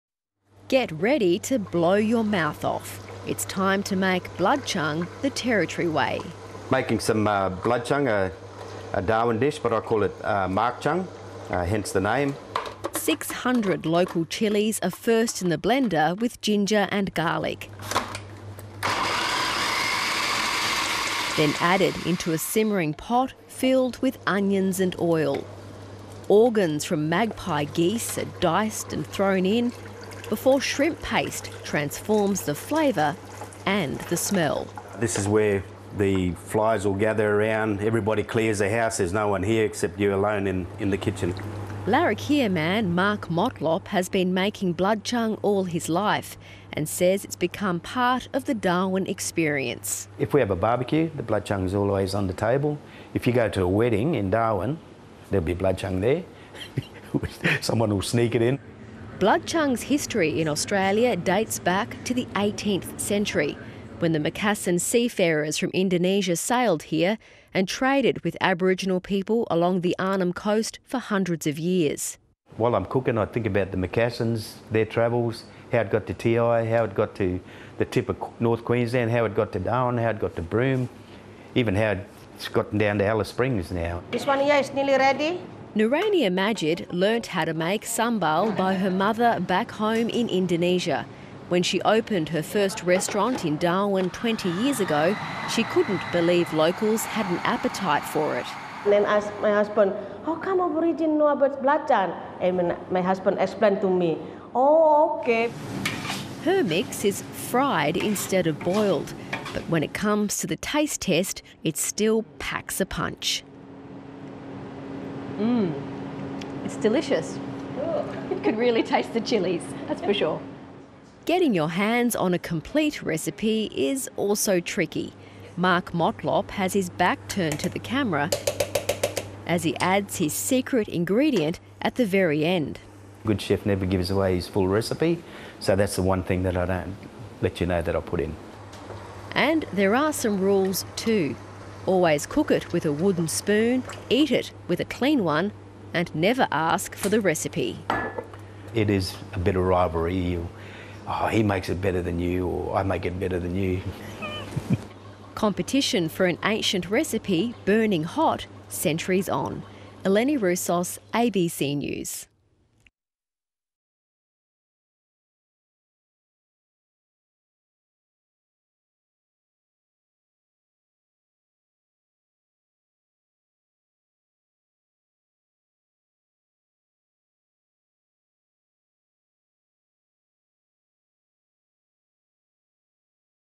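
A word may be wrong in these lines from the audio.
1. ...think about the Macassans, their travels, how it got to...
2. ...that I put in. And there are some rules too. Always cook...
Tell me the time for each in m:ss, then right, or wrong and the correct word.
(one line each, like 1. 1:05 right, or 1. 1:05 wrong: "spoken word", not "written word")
1. 1:13 right
2. 2:17 right.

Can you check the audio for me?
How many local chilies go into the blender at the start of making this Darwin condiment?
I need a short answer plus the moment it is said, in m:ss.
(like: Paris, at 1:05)
600, at 0:12.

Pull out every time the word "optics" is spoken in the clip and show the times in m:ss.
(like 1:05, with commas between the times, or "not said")
not said.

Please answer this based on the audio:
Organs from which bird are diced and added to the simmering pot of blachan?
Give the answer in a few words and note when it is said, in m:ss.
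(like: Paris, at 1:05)
magpie geese, at 0:27.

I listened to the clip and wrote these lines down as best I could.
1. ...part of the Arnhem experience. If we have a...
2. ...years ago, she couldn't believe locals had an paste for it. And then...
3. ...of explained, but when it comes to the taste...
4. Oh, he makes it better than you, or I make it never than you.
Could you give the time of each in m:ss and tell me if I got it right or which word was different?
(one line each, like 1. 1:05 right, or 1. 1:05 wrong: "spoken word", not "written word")
1. 0:47 wrong: "Darwin", not "Arnhem"
2. 1:34 wrong: "appetite", not "paste"
3. 1:48 wrong: "boiled", not "explained"
4. 2:31 wrong: "better", not "never".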